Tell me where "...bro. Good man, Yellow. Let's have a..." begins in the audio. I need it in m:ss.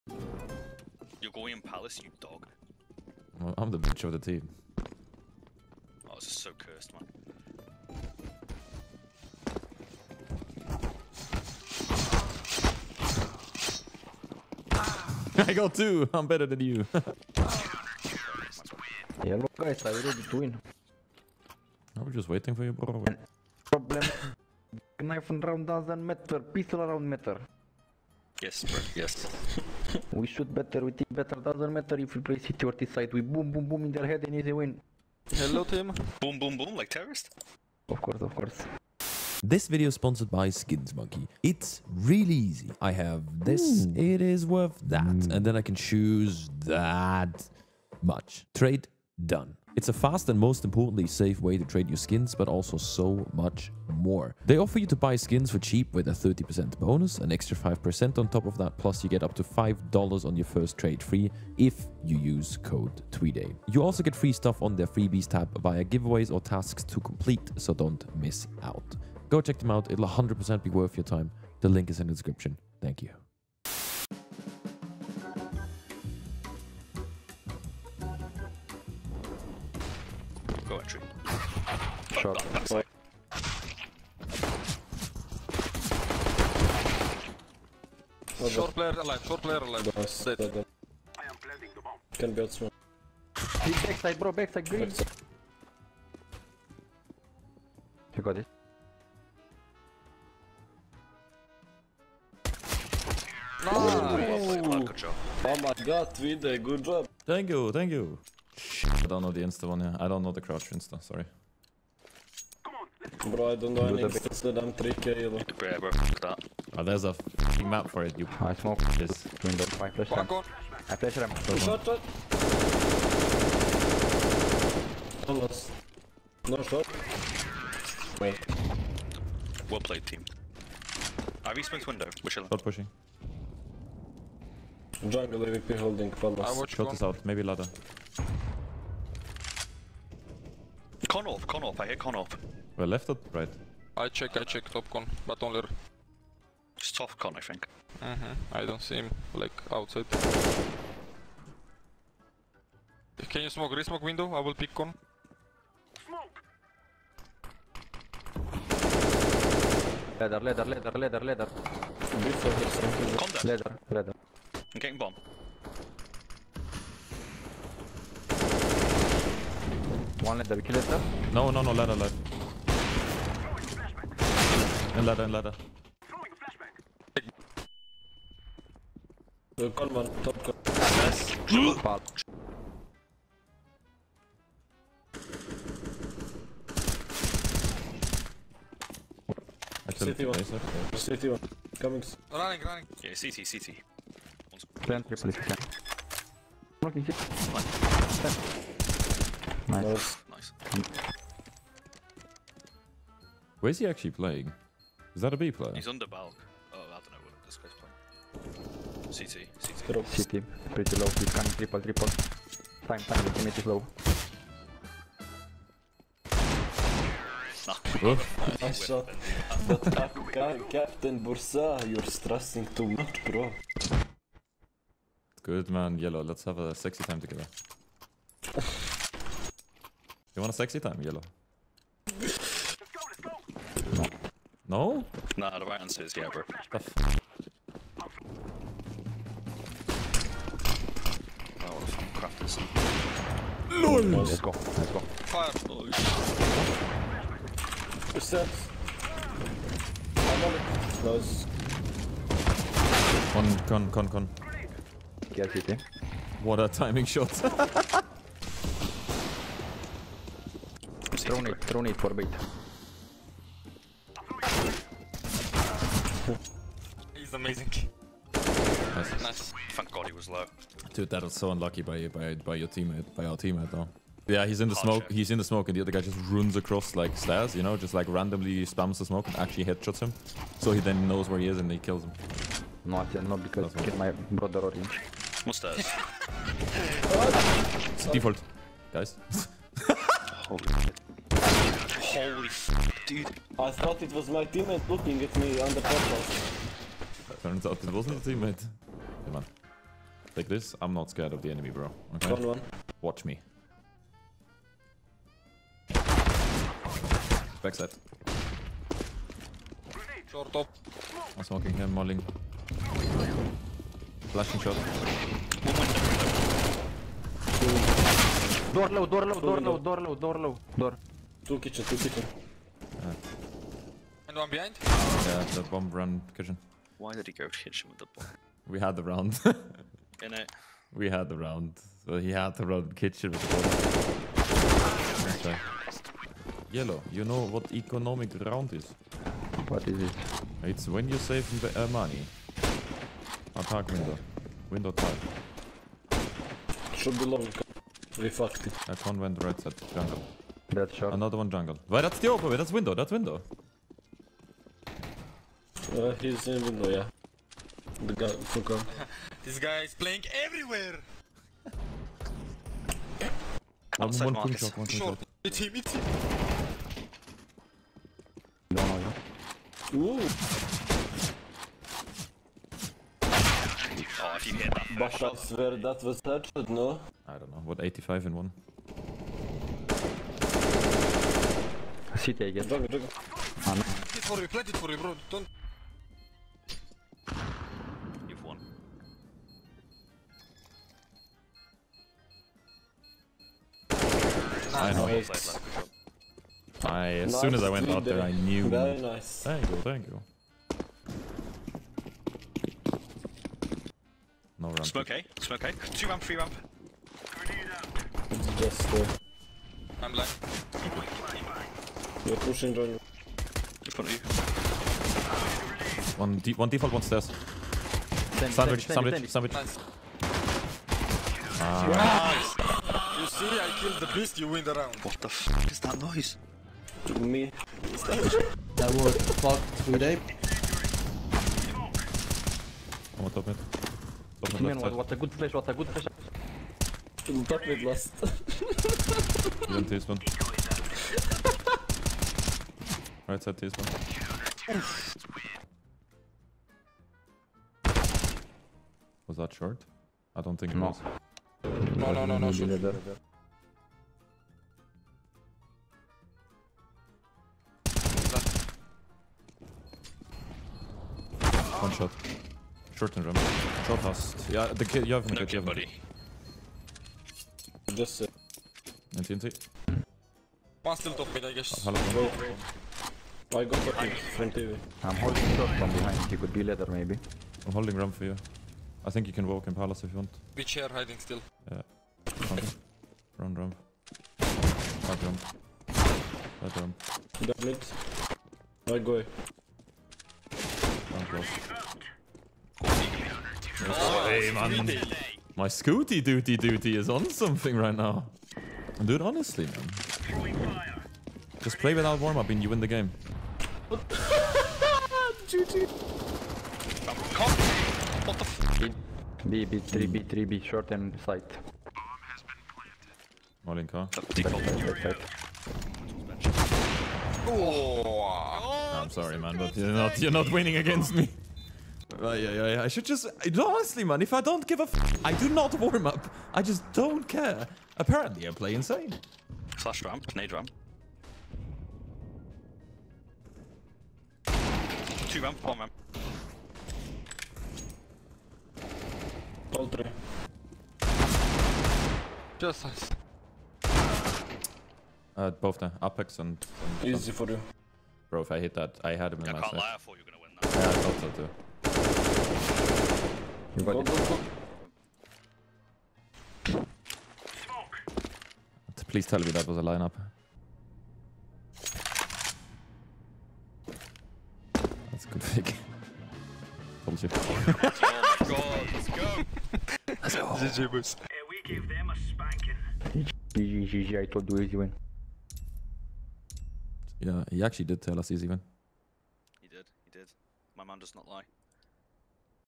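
3:43.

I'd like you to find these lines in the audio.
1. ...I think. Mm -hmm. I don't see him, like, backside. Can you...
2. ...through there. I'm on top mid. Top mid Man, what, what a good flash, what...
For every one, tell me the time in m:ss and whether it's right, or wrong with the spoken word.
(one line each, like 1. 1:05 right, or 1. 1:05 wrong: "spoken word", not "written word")
1. 2:27 wrong: "outside", not "backside"
2. 7:09 right.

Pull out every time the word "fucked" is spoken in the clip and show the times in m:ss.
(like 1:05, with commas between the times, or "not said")
5:48, 7:09.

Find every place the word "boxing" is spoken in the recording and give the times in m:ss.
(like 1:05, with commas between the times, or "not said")
not said.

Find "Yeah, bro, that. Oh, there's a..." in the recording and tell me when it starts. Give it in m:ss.
1:55.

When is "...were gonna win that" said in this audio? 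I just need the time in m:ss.
9:10.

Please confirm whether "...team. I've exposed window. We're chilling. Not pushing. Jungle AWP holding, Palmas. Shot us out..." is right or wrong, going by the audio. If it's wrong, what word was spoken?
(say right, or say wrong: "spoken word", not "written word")
right.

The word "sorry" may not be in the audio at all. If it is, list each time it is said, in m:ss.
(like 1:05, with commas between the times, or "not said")
1:51, 8:39.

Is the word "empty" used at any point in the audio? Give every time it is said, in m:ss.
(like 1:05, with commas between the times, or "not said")
not said.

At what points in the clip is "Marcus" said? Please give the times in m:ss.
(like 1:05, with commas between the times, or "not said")
6:04.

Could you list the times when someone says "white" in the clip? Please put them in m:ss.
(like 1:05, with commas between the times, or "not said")
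not said.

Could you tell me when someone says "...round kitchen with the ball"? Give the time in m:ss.
5:32.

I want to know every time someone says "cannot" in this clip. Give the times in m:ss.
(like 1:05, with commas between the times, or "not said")
4:43.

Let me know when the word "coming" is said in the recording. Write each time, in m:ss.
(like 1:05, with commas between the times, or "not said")
3:11, 3:31.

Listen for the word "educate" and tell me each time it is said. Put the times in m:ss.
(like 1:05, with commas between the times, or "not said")
not said.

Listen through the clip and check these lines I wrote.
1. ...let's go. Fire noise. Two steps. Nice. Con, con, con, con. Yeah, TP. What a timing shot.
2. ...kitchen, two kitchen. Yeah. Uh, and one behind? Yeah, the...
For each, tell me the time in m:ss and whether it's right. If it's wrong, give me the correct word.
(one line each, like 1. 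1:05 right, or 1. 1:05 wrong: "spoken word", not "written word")
1. 4:04 right
2. 5:21 right.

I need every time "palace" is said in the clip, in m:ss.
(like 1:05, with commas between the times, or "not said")
0:01, 7:59.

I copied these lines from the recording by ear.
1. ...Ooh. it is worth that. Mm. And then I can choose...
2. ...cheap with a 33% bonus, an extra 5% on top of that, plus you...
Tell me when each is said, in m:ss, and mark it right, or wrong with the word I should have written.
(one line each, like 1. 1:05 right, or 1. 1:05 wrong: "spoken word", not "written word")
1. 0:43 right
2. 0:55 wrong: "30", not "33".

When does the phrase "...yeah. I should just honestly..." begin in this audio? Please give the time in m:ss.
8:42.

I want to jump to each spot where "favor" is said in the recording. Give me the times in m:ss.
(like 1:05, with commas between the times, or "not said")
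not said.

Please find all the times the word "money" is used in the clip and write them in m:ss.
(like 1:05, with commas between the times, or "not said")
5:41.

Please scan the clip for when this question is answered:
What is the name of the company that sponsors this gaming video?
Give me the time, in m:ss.
0:40.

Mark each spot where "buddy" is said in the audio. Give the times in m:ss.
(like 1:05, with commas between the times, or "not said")
7:45.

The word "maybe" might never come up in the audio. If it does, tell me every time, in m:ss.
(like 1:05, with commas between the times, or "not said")
2:17, 7:56.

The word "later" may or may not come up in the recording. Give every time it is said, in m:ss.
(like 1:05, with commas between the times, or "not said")
7:56.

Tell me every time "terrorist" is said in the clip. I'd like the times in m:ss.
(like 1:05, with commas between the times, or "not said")
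0:36.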